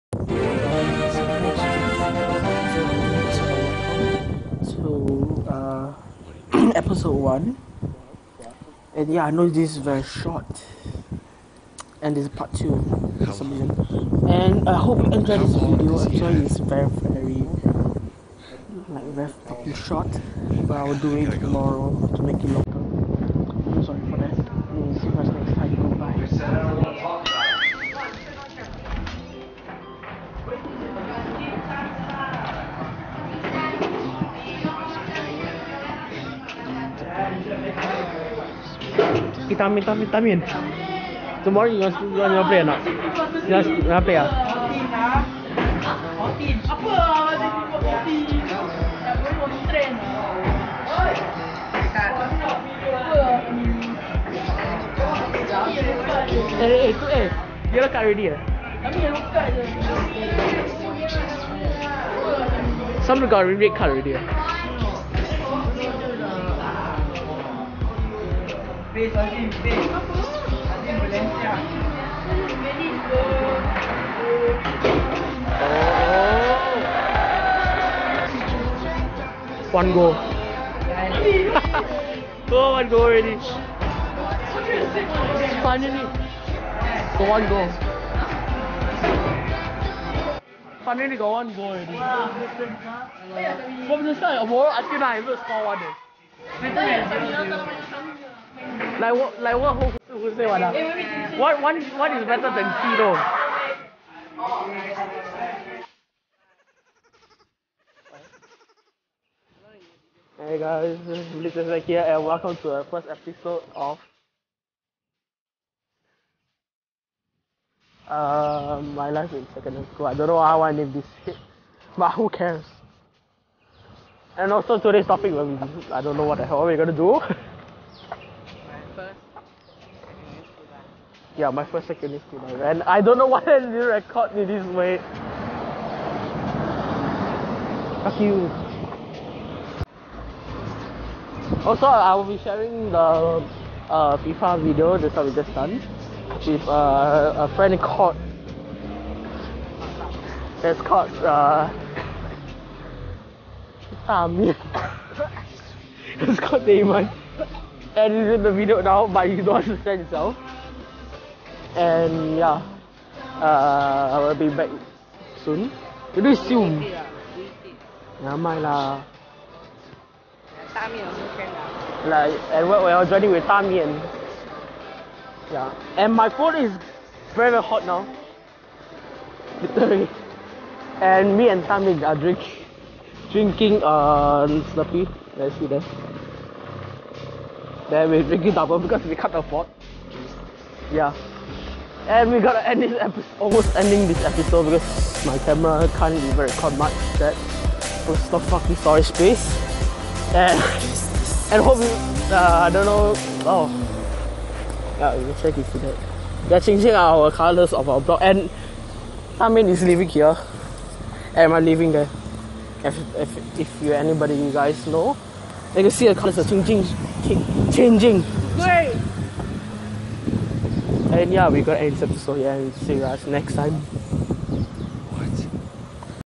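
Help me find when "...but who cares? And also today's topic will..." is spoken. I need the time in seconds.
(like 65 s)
121 s.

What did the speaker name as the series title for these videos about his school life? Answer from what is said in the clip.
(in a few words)
My life in secondary school.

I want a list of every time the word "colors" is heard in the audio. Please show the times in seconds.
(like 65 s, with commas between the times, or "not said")
207 s, 216 s.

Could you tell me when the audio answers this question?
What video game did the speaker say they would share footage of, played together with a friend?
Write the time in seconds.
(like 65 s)
144 s.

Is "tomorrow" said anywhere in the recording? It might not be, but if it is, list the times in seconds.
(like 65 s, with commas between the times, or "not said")
21 s, 41 s.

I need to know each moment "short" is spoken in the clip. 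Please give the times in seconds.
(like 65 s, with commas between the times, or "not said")
10 s, 19 s.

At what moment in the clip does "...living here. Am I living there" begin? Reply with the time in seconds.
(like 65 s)
209 s.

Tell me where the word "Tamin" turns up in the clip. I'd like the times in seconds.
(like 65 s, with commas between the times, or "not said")
209 s.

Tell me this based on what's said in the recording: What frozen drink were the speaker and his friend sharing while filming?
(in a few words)
Slurpee.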